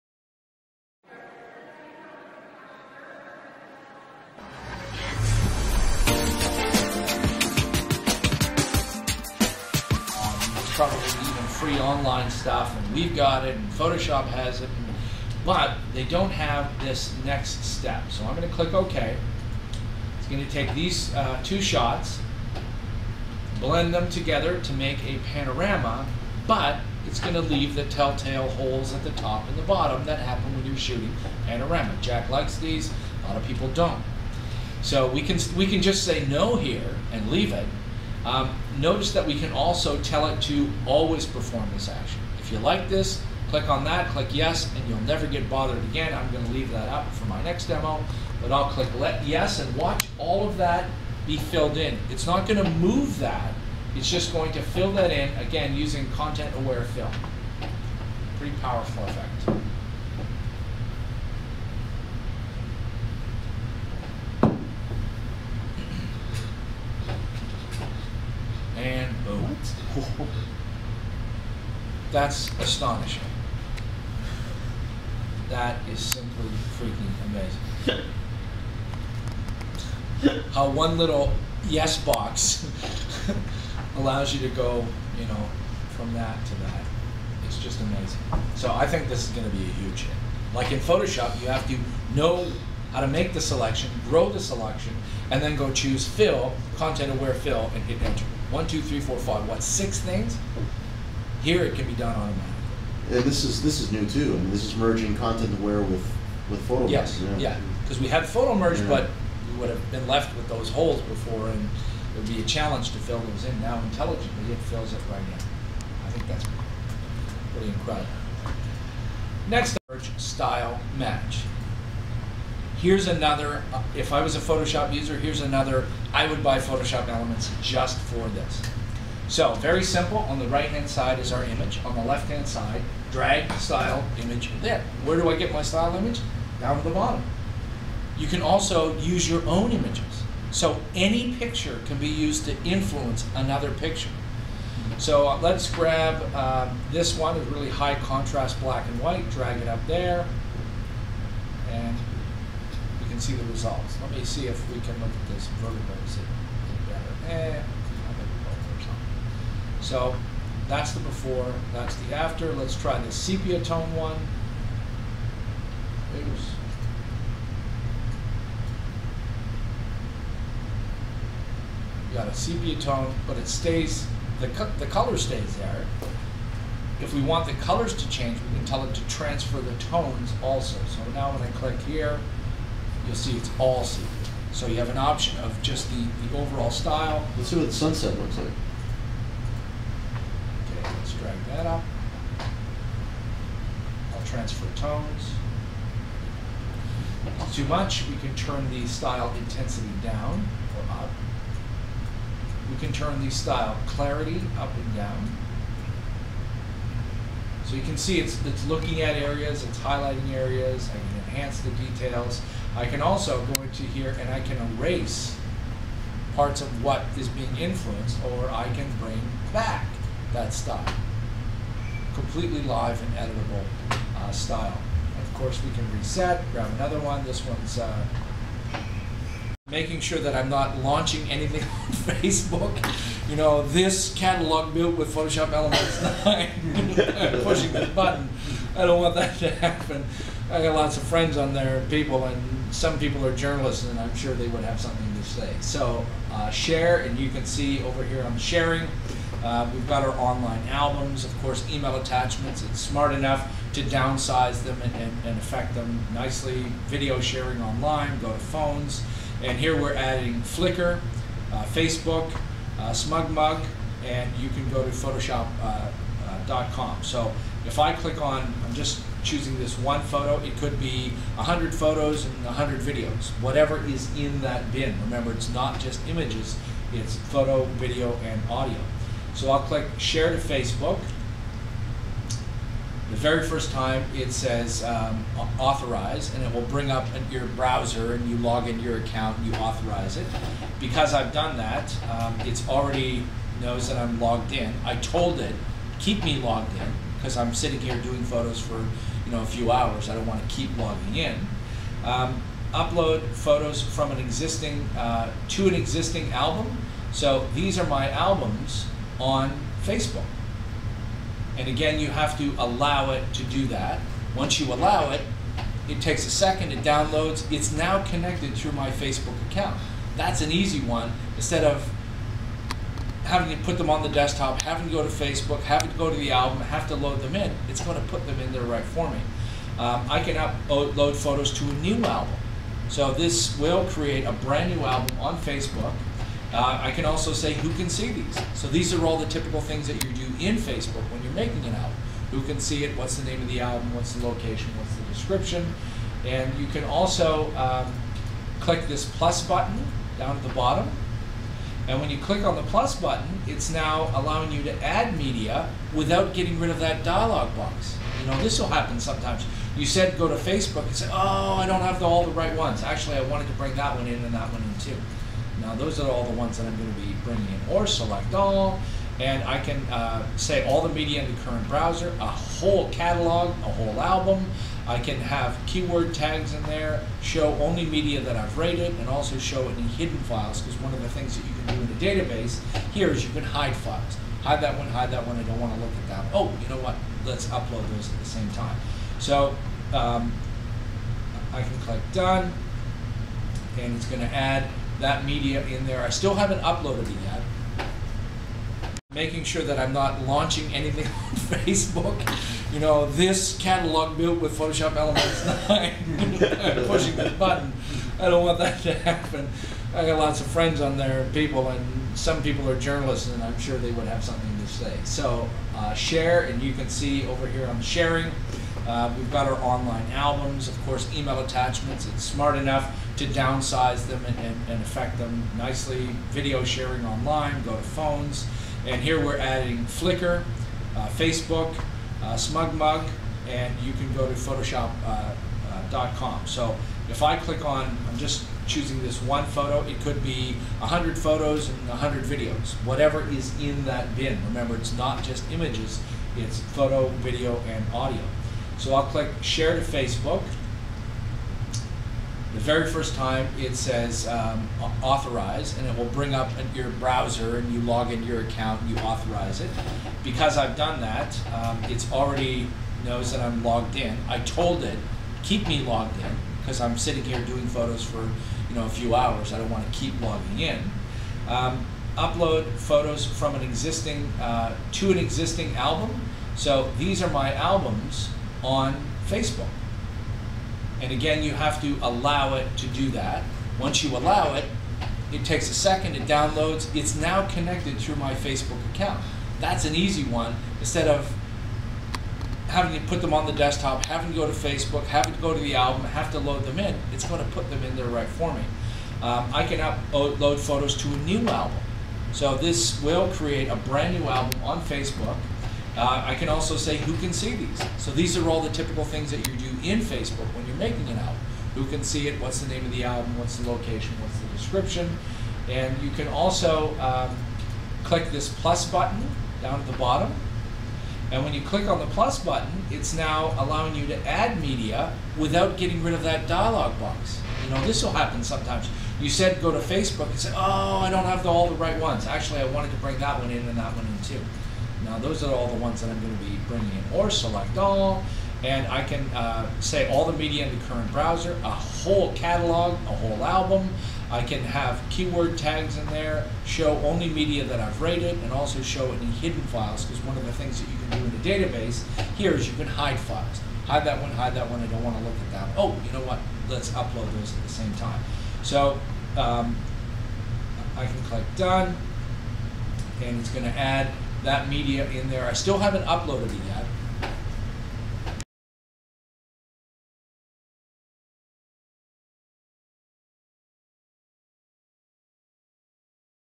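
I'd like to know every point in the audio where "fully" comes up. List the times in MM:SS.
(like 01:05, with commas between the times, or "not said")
not said.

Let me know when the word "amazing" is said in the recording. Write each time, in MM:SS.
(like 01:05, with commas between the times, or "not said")
01:17, 01:27.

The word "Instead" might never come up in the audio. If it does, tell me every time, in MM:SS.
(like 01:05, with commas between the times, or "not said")
05:21, 08:10.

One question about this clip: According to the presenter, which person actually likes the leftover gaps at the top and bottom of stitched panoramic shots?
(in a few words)
Jack.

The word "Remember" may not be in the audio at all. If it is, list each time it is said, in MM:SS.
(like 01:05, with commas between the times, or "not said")
04:35, 07:24.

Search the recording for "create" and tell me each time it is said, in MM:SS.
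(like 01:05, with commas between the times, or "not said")
05:33, 08:23.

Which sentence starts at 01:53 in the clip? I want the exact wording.
Now intelligently, it fills it right in.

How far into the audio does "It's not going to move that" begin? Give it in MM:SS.
00:52.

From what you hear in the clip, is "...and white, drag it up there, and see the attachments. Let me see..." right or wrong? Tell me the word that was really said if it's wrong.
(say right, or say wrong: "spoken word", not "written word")
wrong: "results", not "attachments".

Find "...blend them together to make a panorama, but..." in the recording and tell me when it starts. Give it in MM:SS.
00:23.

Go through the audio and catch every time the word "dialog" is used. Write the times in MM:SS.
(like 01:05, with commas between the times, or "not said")
05:57, 08:46.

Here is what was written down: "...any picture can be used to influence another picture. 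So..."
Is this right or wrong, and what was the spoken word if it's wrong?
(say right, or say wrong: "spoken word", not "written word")
right.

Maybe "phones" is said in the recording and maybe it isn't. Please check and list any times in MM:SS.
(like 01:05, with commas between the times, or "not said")
04:18, 07:07.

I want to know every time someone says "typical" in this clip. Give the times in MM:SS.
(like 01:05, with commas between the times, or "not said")
05:39, 08:28.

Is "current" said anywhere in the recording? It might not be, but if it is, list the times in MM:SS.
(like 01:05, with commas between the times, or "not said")
06:11, 09:00.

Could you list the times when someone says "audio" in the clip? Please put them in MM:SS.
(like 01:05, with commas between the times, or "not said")
04:38, 07:27.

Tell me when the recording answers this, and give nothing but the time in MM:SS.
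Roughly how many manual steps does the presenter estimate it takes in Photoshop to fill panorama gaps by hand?
01:39.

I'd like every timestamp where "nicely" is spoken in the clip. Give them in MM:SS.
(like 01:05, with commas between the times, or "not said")
04:16, 07:05.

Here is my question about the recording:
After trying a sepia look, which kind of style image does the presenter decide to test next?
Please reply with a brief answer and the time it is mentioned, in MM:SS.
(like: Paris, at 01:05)
Sunset, at 03:07.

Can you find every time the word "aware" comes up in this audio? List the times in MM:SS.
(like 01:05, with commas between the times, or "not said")
00:56, 01:37, 01:45.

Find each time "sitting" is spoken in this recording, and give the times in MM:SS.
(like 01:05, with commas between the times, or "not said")
04:57, 07:46.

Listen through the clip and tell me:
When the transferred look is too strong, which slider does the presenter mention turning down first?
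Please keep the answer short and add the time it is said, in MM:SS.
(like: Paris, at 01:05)
Style intensity, at 03:18.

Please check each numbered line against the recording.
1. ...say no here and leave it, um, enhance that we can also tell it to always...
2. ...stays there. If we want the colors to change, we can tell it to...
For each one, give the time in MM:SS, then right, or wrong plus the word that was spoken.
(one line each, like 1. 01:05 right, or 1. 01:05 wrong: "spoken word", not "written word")
1. 00:36 wrong: "notice", not "enhance"
2. 02:55 right.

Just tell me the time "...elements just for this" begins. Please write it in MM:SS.
02:07.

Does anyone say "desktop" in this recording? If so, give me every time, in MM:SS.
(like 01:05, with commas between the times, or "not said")
05:24, 08:13.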